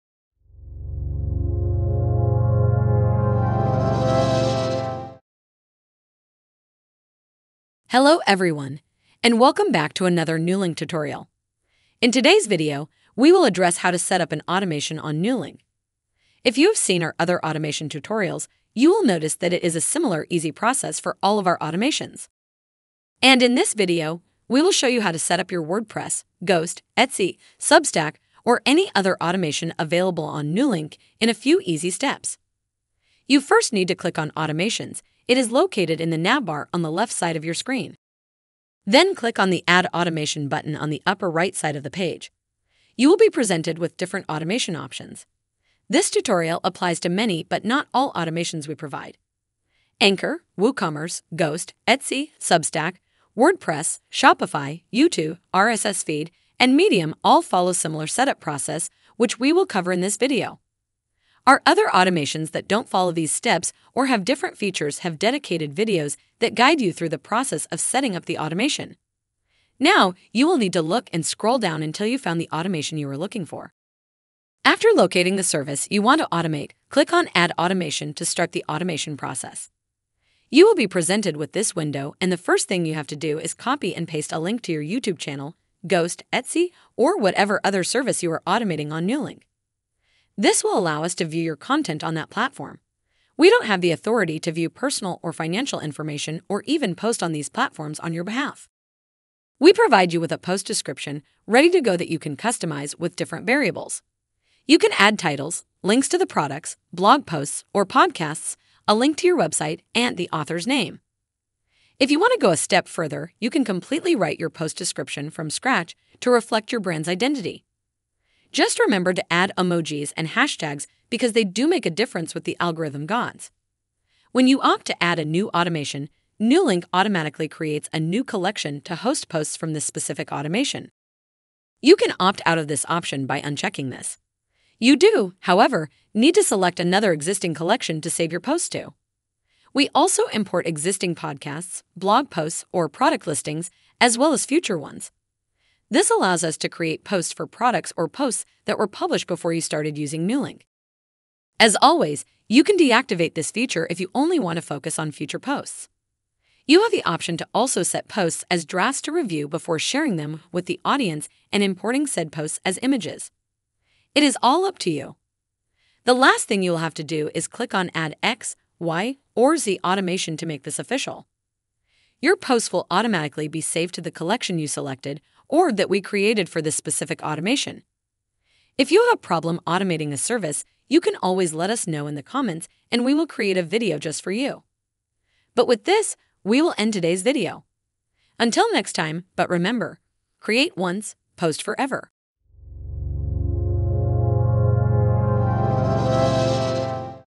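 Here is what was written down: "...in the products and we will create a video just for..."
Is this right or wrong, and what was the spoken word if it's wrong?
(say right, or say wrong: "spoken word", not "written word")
wrong: "comments", not "products".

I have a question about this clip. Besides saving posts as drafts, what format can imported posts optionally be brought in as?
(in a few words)
Images.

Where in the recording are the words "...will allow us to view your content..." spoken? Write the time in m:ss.
1:30.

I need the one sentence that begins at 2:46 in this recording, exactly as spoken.
The last thing you'll have to do is click on Add X, Y, or Z automation to make this official.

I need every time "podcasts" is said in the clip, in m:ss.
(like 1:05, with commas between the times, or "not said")
1:47, 2:21.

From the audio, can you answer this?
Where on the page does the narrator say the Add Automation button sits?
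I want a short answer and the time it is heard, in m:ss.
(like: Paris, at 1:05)
Upper right side, at 0:41.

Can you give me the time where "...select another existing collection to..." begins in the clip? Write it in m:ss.
2:16.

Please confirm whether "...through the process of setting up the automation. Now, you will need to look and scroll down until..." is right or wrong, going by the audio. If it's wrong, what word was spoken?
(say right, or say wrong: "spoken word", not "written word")
right.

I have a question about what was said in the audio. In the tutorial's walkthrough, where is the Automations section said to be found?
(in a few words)
Navbar on the left.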